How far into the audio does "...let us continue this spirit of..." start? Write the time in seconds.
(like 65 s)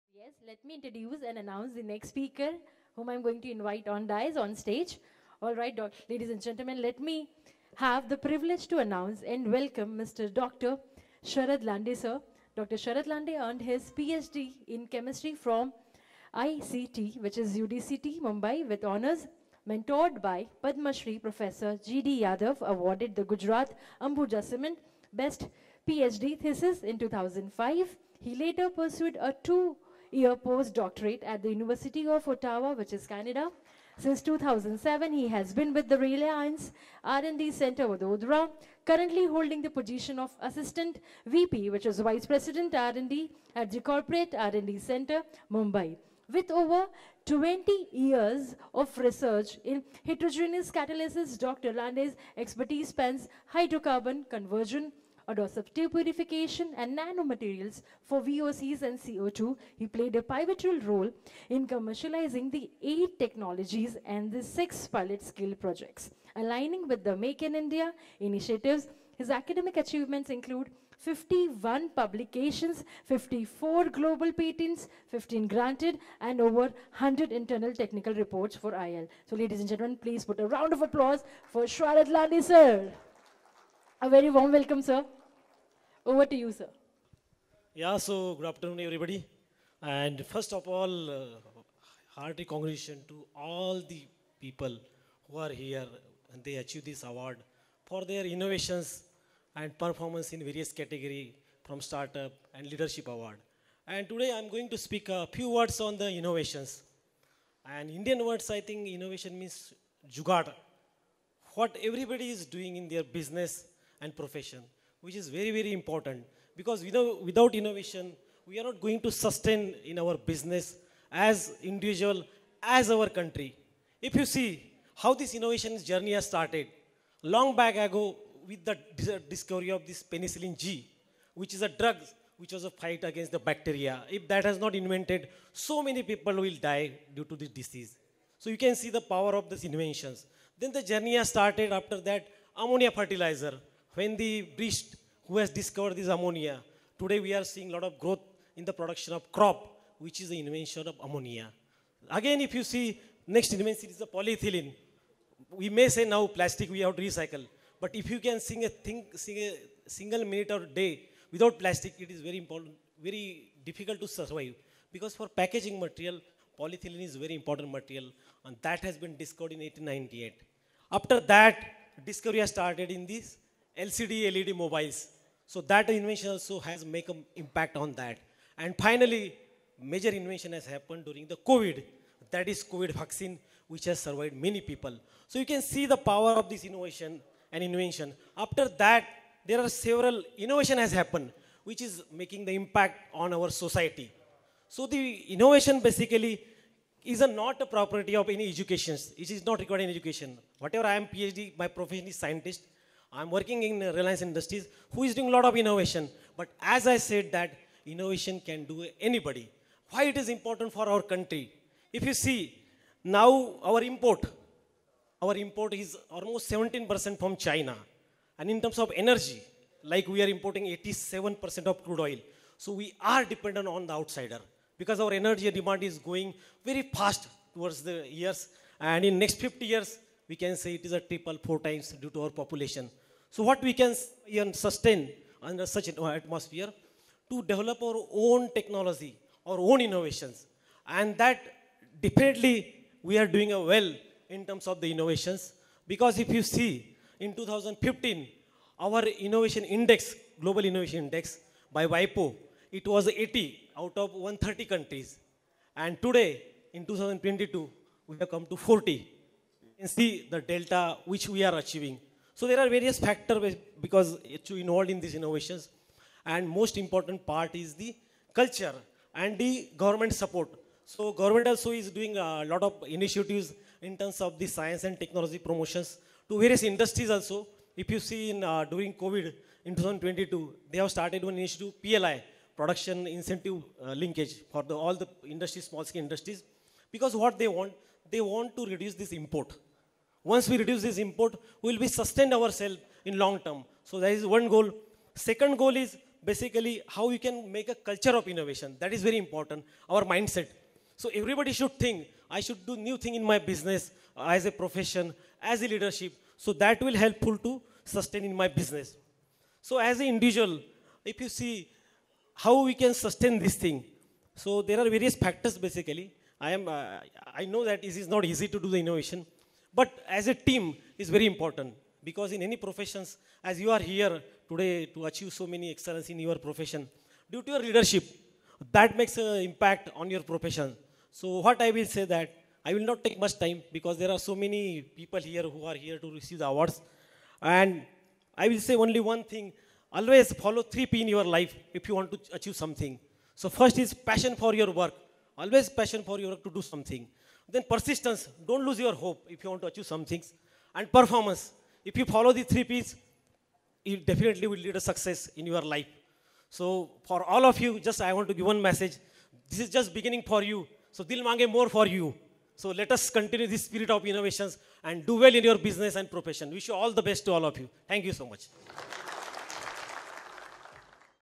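362 s.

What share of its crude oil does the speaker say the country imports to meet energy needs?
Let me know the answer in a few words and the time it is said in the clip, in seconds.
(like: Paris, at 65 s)
87%, at 220 s.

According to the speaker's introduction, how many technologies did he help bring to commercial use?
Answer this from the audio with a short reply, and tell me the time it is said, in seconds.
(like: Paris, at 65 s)
8, at 62 s.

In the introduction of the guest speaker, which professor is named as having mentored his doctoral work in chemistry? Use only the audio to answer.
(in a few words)
G.D. Yadav.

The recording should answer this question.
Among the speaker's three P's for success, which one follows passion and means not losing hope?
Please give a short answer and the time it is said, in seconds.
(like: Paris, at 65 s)
Persistence, at 347 s.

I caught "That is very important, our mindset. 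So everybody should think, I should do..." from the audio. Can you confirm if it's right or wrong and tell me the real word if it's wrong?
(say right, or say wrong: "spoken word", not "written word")
right.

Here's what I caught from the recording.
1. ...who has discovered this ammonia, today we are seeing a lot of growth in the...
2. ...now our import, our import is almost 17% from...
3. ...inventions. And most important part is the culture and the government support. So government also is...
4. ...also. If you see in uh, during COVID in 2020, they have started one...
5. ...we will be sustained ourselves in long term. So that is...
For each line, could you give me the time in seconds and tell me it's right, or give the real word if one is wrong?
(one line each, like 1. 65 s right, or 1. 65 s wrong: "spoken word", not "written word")
1. 145 s right
2. 213 s right
3. 265 s wrong: "innovations", not "inventions"
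4. 277 s wrong: "2022", not "2020"
5. 291 s right.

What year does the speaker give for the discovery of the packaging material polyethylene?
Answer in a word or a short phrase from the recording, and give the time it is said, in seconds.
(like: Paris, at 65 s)
1898, at 169 s.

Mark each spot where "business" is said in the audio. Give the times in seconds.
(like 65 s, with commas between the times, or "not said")
113 s, 120 s, 303 s, 308 s, 365 s.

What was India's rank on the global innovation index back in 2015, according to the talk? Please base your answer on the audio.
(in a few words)
80.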